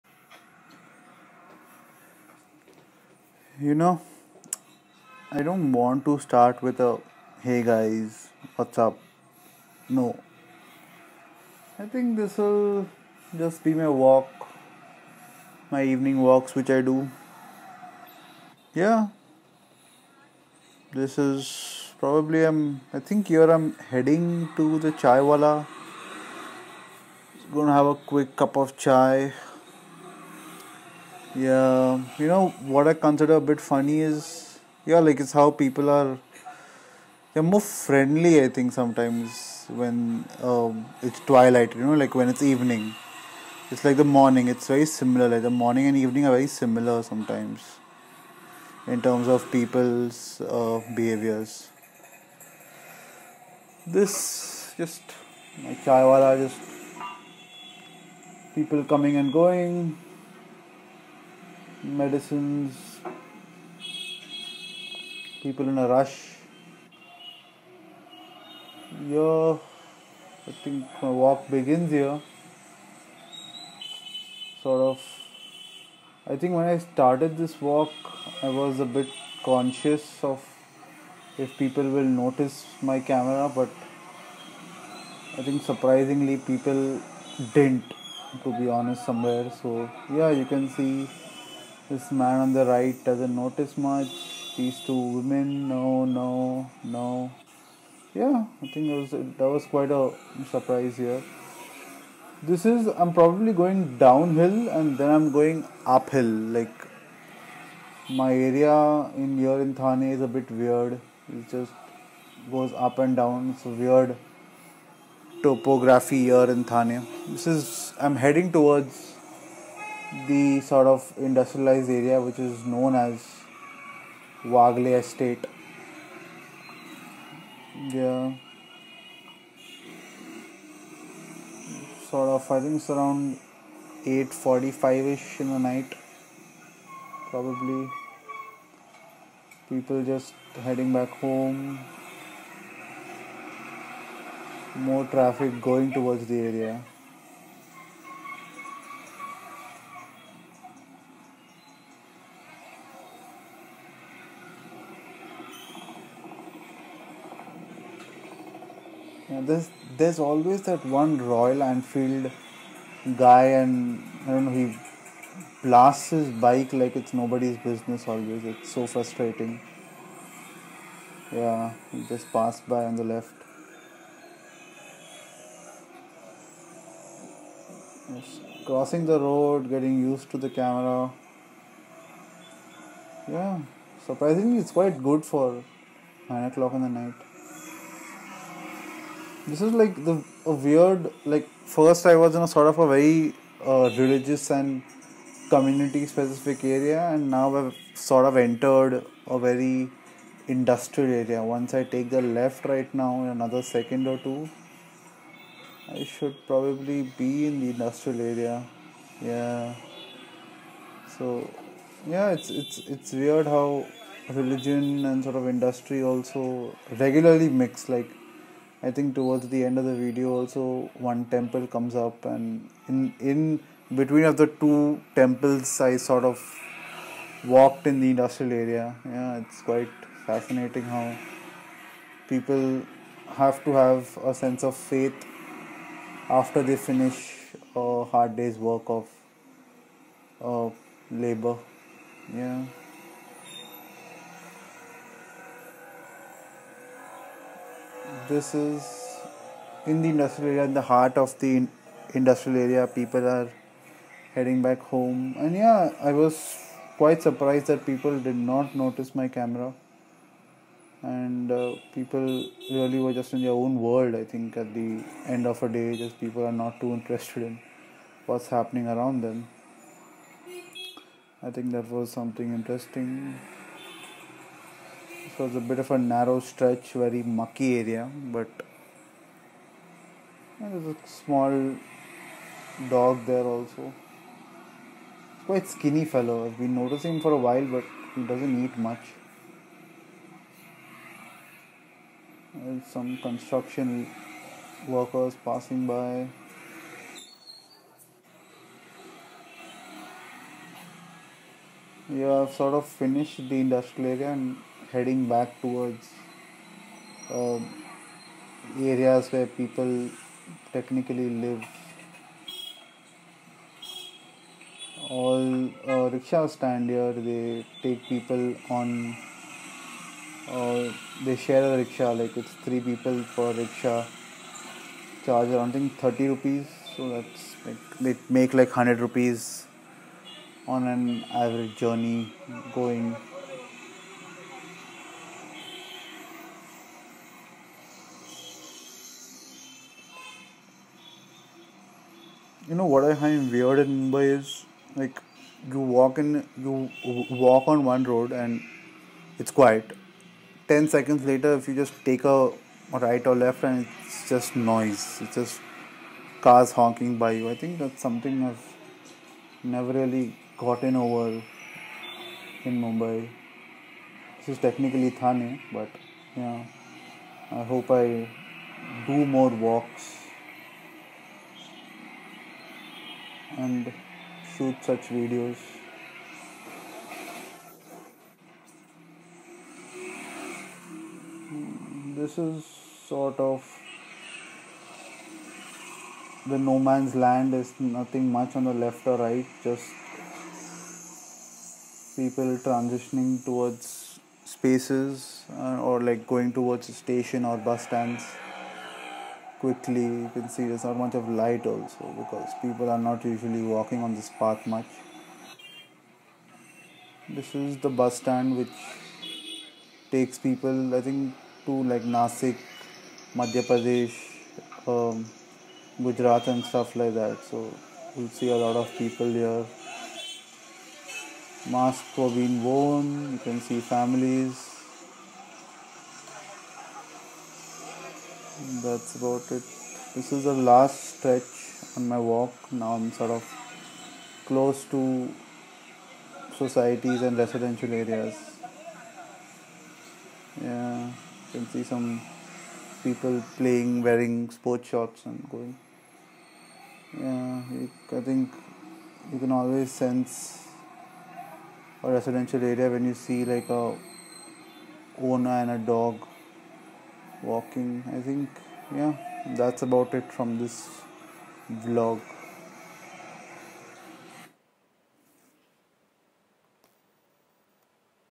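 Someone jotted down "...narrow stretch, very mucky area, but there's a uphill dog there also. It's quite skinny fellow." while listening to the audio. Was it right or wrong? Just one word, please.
wrong.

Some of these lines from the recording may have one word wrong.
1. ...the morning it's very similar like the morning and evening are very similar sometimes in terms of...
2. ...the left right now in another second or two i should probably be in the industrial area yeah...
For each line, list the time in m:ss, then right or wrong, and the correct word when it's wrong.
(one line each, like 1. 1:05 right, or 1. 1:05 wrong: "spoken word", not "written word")
1. 0:43 right
2. 3:22 right.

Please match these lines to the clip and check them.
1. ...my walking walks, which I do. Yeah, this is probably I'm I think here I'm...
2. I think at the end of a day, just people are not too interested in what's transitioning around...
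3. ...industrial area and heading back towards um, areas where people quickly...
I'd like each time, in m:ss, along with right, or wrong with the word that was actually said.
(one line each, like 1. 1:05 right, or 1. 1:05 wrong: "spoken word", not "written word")
1. 0:15 wrong: "evening", not "walking"
2. 4:24 wrong: "happening", not "transitioning"
3. 5:03 wrong: "technically", not "quickly".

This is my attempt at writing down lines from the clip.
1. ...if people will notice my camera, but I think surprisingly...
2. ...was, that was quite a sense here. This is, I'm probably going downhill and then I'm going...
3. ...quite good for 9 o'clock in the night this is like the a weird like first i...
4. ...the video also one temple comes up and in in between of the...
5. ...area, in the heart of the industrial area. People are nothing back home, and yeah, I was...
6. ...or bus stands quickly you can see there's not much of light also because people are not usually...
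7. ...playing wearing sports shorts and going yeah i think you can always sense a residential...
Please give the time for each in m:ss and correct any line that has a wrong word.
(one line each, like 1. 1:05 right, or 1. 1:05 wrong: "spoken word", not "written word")
1. 1:21 right
2. 1:39 wrong: "surprise", not "sense"
3. 3:04 right
4. 3:39 right
5. 4:10 wrong: "heading", not "nothing"
6. 6:37 right
7. 7:23 right.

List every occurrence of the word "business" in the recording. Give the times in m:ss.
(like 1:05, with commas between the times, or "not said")
2:47.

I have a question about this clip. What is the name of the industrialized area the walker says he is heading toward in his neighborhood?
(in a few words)
Wagley Estate.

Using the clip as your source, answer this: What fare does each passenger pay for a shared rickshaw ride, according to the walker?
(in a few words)
30 rupees.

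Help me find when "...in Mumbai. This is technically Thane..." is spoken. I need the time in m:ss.
6:02.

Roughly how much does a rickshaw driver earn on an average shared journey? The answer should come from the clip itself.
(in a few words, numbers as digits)
100 rupees.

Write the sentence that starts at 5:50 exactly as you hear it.
Ten seconds later, if you just take a right or left, and it's just noise.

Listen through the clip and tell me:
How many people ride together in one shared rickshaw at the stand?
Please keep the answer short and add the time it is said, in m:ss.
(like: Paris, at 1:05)
3, at 5:22.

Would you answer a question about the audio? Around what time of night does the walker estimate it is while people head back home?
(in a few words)
8:45.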